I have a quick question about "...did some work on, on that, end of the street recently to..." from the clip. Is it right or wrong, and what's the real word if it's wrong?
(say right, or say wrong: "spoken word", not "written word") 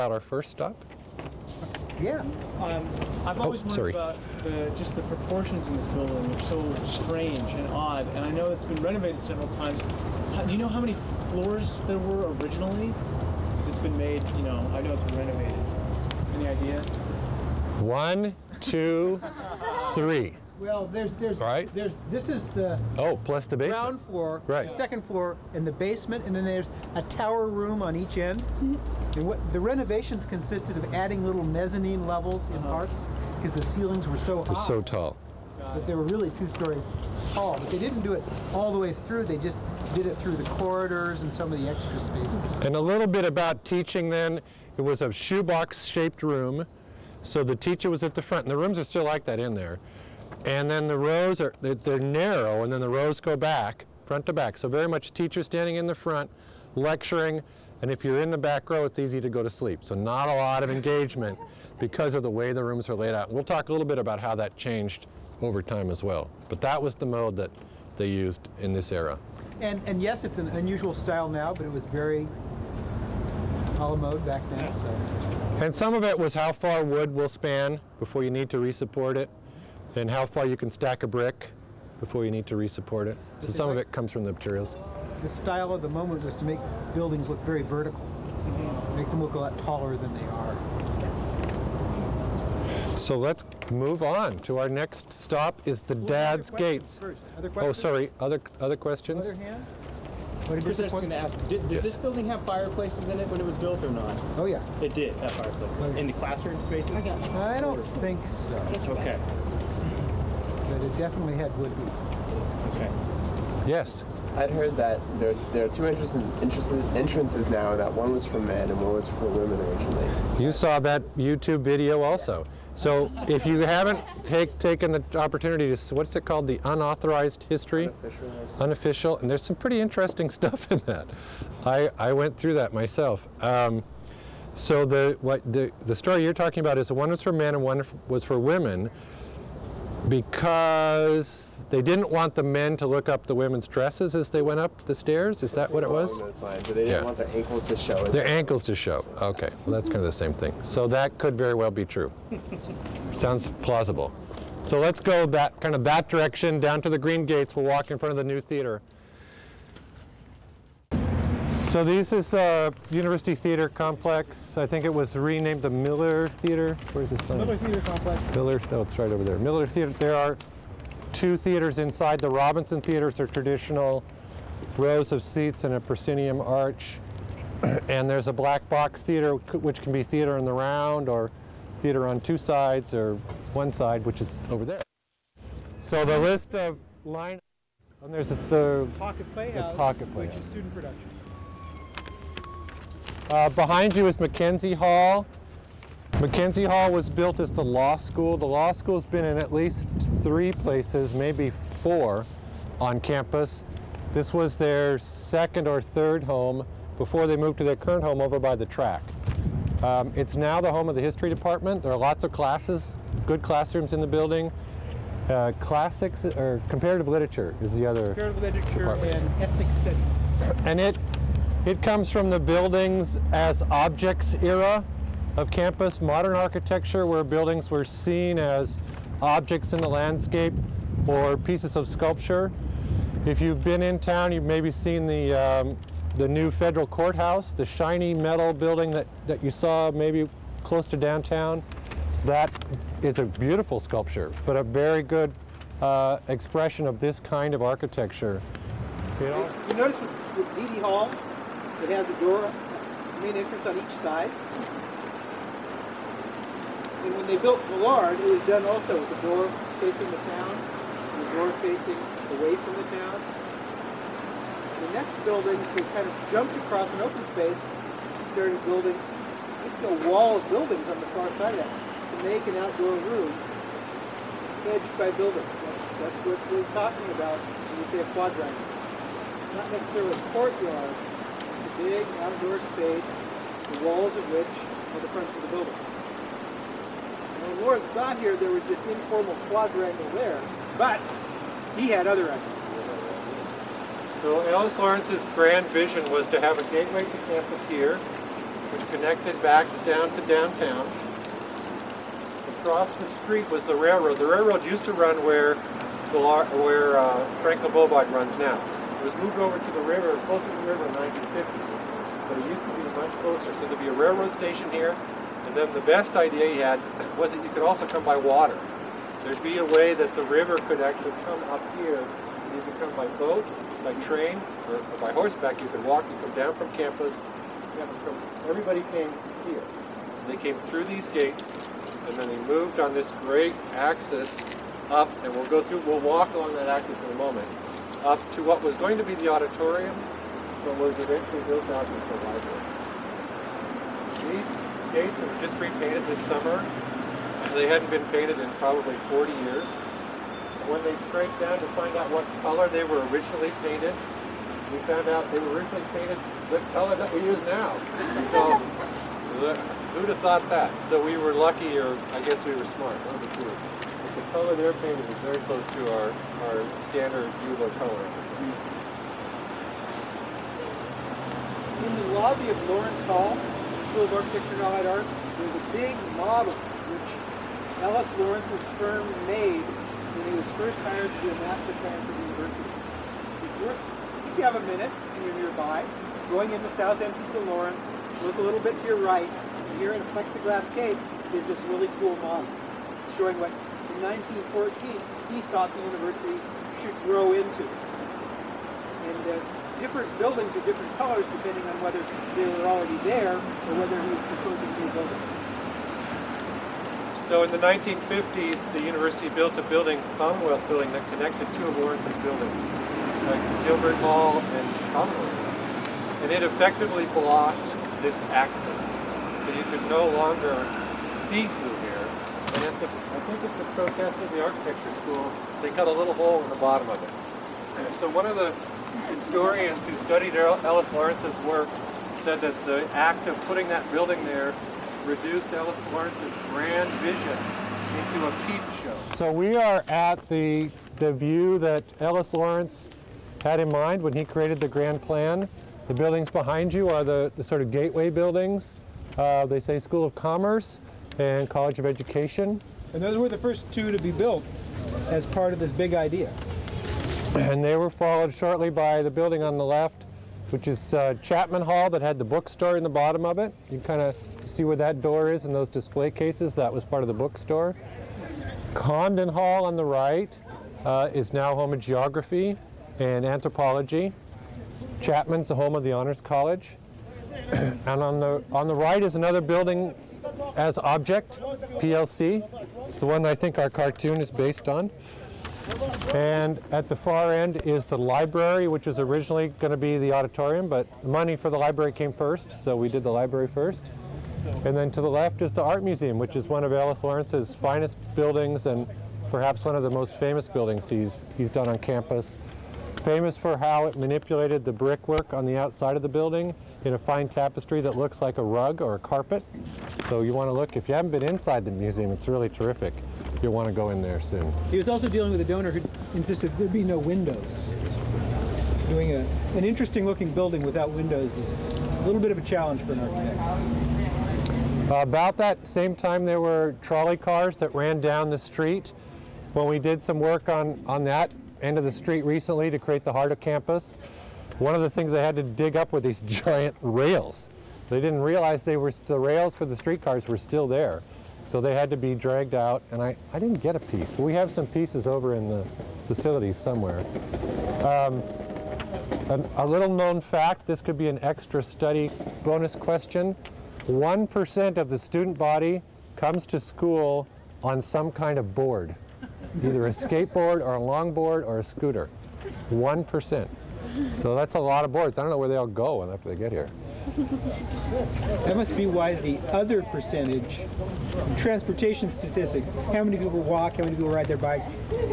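right.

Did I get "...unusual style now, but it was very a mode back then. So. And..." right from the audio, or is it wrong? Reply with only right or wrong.
right.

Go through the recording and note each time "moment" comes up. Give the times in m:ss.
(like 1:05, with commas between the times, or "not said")
1:25, 5:37.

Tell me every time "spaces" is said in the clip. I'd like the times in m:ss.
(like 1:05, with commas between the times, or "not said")
0:41, 1:46, 4:27, 4:42.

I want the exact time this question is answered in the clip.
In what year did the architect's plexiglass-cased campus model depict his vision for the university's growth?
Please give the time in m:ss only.
6:34.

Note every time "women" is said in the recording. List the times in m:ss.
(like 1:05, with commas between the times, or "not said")
1:59, 2:18, 2:23.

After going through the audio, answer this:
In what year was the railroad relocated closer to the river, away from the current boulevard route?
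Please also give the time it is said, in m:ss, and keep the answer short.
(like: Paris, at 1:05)
1950, at 5:10.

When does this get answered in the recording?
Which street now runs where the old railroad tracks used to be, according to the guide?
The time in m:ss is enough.
5:07.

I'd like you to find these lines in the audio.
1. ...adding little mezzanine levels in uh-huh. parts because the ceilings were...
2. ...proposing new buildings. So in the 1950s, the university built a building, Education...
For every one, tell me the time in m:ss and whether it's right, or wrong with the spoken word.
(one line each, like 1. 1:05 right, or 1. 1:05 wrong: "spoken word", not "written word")
1. 0:30 right
2. 6:44 wrong: "Commonwealth", not "Education".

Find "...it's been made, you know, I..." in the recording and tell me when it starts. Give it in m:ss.
0:13.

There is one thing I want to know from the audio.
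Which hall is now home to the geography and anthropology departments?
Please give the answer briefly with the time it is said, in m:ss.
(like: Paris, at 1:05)
Condon Hall, at 7:48.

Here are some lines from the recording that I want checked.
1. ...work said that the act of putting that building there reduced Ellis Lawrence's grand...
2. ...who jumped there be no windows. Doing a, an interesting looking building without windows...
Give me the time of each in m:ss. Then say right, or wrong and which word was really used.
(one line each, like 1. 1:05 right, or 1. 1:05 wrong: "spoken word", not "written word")
1. 7:11 right
2. 8:35 wrong: "insisted", not "jumped".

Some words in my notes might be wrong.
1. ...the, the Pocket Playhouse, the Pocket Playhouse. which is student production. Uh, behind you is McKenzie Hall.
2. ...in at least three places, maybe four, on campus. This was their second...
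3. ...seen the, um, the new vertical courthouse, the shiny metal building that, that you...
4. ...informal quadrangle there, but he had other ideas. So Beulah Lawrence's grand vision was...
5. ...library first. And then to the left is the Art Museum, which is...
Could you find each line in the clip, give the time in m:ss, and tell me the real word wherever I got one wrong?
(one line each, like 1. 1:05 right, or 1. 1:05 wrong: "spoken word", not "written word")
1. 3:08 right
2. 3:19 right
3. 3:54 wrong: "federal", not "vertical"
4. 4:48 wrong: "Ellis", not "Beulah"
5. 8:13 right.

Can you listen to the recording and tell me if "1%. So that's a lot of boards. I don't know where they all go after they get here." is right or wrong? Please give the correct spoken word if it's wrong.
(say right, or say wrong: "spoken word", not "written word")
right.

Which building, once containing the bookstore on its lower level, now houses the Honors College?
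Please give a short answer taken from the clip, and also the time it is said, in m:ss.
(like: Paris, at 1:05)
Chapman Hall, at 7:41.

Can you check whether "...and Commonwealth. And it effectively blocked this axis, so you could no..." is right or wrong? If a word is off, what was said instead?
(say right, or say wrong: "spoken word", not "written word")
right.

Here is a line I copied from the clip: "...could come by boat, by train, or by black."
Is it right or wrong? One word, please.
wrong.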